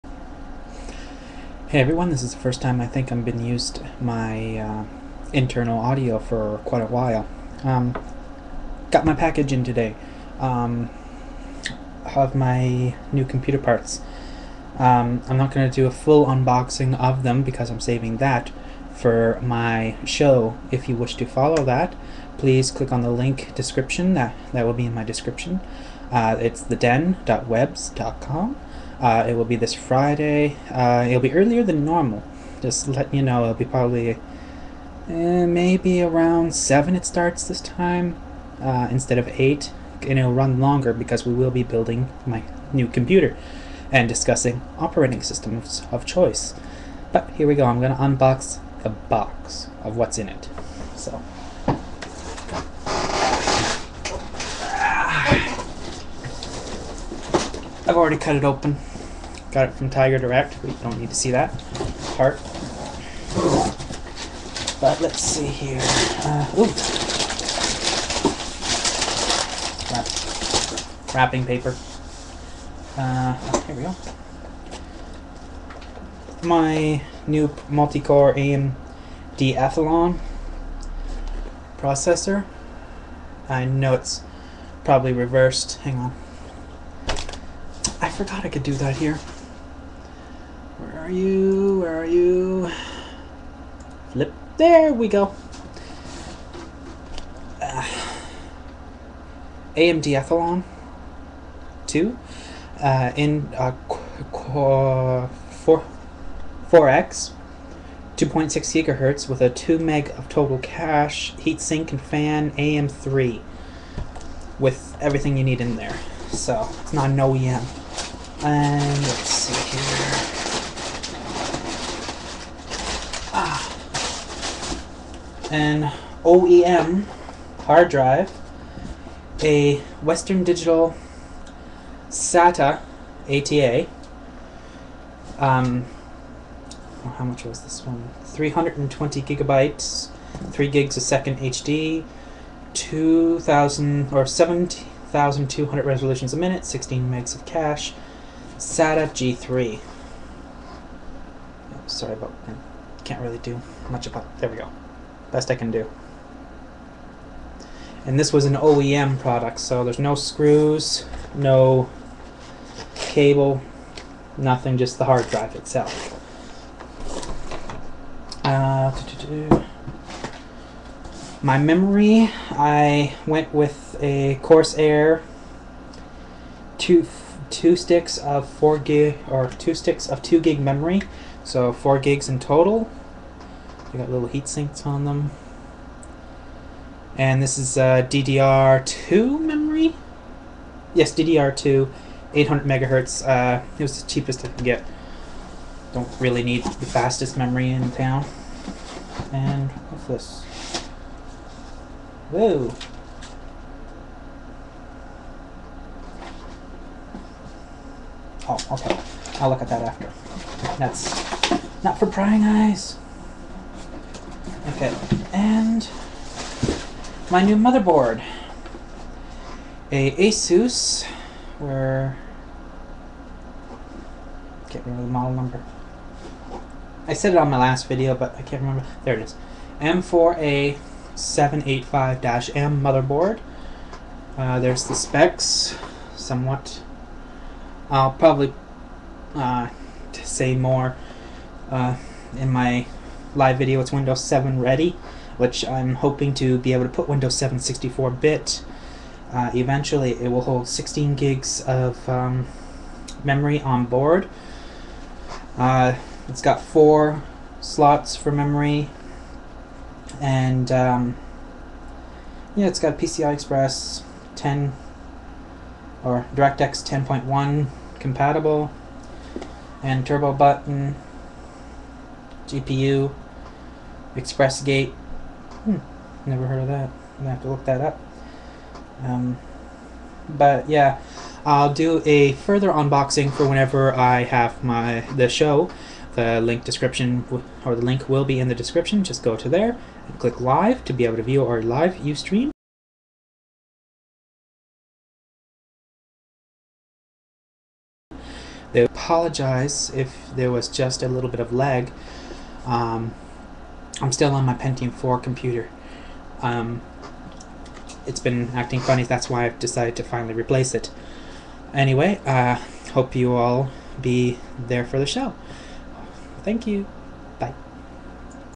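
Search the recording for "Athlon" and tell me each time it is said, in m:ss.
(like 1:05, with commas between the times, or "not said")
1:19, 1:40.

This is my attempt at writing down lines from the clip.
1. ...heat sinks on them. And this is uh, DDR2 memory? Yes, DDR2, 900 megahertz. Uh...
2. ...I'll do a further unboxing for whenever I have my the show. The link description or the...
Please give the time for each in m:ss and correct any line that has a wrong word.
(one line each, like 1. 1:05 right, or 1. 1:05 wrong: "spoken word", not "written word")
1. 3:04 wrong: "800", not "900"
2. 4:41 right.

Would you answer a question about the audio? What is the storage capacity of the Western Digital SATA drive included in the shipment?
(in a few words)
320 gigabytes.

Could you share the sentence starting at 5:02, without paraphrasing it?
Um, I'm still on my Pentium 4 computer.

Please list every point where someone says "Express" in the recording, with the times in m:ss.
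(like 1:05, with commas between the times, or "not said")
4:23, 4:34.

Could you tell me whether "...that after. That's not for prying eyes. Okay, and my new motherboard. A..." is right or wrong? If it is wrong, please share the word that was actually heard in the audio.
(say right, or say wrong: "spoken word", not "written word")
right.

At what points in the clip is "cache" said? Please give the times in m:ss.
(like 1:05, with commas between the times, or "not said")
1:50, 2:27.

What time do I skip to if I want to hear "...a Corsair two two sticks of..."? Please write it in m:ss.
2:54.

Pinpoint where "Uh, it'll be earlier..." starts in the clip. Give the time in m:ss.
0:30.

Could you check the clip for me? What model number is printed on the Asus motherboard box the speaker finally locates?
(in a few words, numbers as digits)
M4A785-M.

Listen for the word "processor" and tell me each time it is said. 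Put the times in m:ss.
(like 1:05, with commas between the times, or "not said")
1:21.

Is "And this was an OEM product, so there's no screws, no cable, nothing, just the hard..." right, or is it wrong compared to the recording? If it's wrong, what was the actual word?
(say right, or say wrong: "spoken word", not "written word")
right.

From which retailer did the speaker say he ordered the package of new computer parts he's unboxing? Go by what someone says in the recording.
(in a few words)
Tiger Direct.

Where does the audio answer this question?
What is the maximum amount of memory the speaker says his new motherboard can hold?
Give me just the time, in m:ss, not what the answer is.
4:10.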